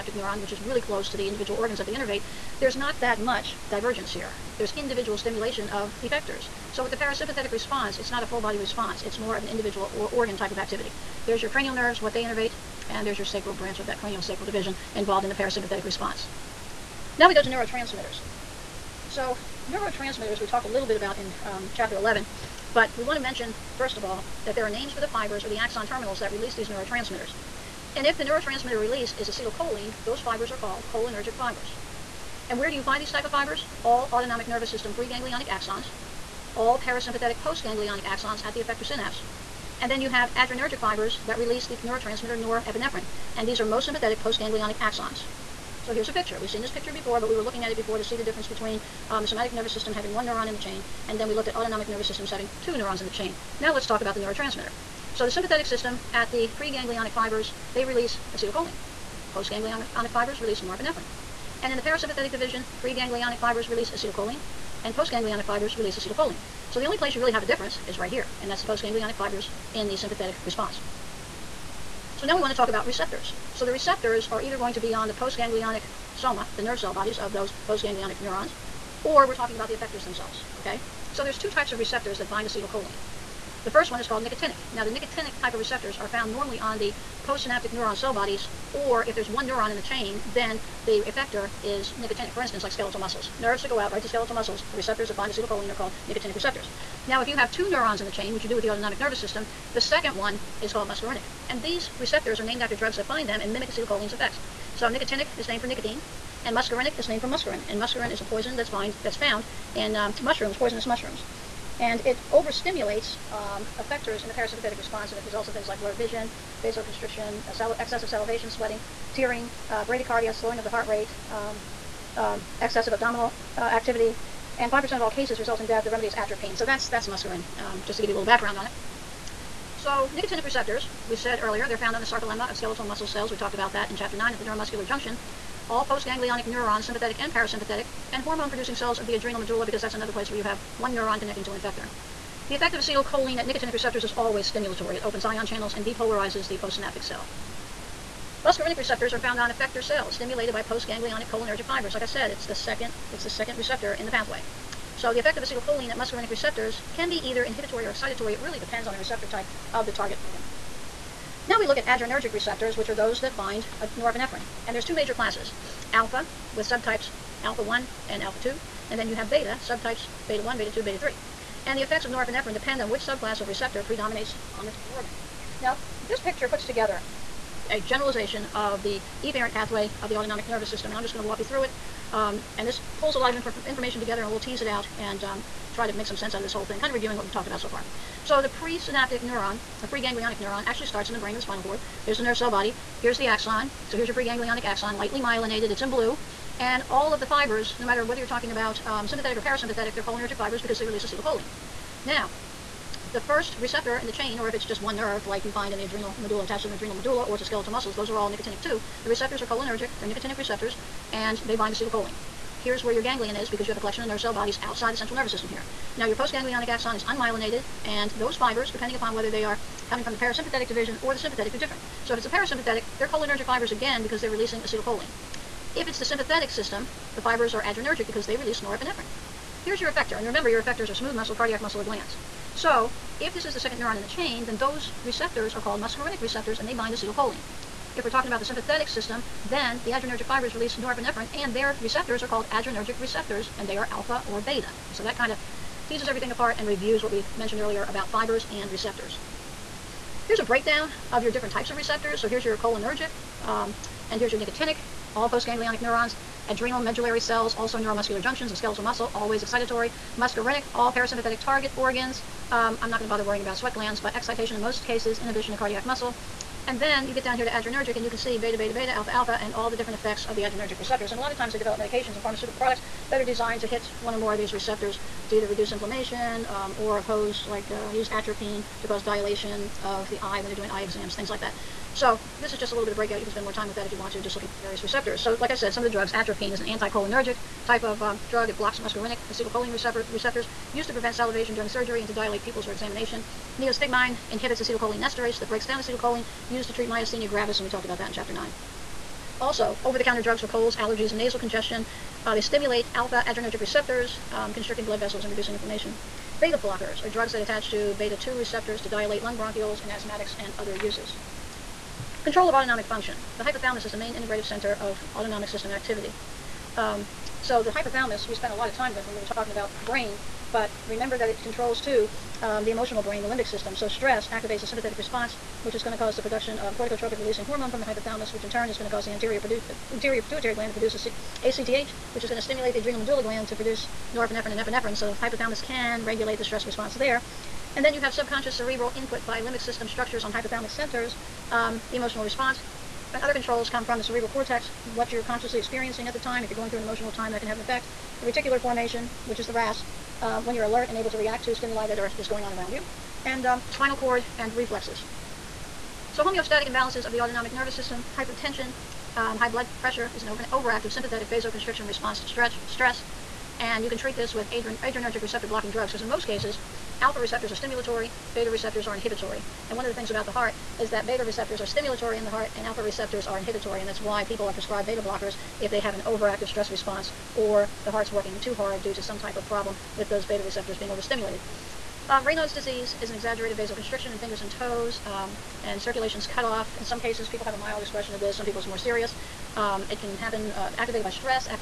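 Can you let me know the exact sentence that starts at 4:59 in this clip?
Also, over-the-counter drugs for colds, allergies, and nasal congestion.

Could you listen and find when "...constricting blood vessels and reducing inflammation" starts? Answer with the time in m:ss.
5:04.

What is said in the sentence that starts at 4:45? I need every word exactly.
So, like I said, some of the drugs, atropine is an anticholinergic type of um, drug.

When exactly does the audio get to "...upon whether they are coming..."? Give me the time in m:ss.
3:38.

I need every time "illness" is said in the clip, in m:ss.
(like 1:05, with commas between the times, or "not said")
not said.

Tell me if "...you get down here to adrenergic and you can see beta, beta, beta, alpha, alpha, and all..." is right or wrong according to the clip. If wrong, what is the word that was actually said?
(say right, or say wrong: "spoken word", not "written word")
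right.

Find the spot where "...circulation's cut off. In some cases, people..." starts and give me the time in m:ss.
6:25.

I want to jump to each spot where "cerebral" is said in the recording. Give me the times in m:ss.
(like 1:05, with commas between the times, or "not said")
5:38, 5:44.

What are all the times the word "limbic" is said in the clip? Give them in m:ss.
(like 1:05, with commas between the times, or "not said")
5:23, 5:39.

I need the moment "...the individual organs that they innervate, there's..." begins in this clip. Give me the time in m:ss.
0:01.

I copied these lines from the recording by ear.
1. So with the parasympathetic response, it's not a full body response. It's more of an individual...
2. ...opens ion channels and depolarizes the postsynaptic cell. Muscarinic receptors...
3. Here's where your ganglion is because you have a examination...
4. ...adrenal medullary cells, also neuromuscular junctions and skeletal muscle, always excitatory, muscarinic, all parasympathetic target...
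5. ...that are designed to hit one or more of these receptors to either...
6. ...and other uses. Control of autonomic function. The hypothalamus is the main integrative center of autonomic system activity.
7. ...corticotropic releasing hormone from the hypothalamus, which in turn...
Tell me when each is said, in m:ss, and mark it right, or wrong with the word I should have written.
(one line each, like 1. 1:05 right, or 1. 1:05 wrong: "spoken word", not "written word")
1. 0:06 right
2. 2:25 right
3. 3:32 wrong: "collection", not "examination"
4. 4:16 right
5. 4:33 right
6. 5:10 right
7. 5:26 right.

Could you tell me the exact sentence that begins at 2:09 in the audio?
So nicotinic receptors, we said earlier, they're found on the sarcolemma of skeletal muscle cells.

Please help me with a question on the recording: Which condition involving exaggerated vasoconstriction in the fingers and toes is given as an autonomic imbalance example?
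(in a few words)
Raynaud's disease.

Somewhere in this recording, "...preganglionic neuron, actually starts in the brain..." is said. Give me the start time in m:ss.
3:09.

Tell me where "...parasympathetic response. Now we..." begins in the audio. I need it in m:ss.
0:15.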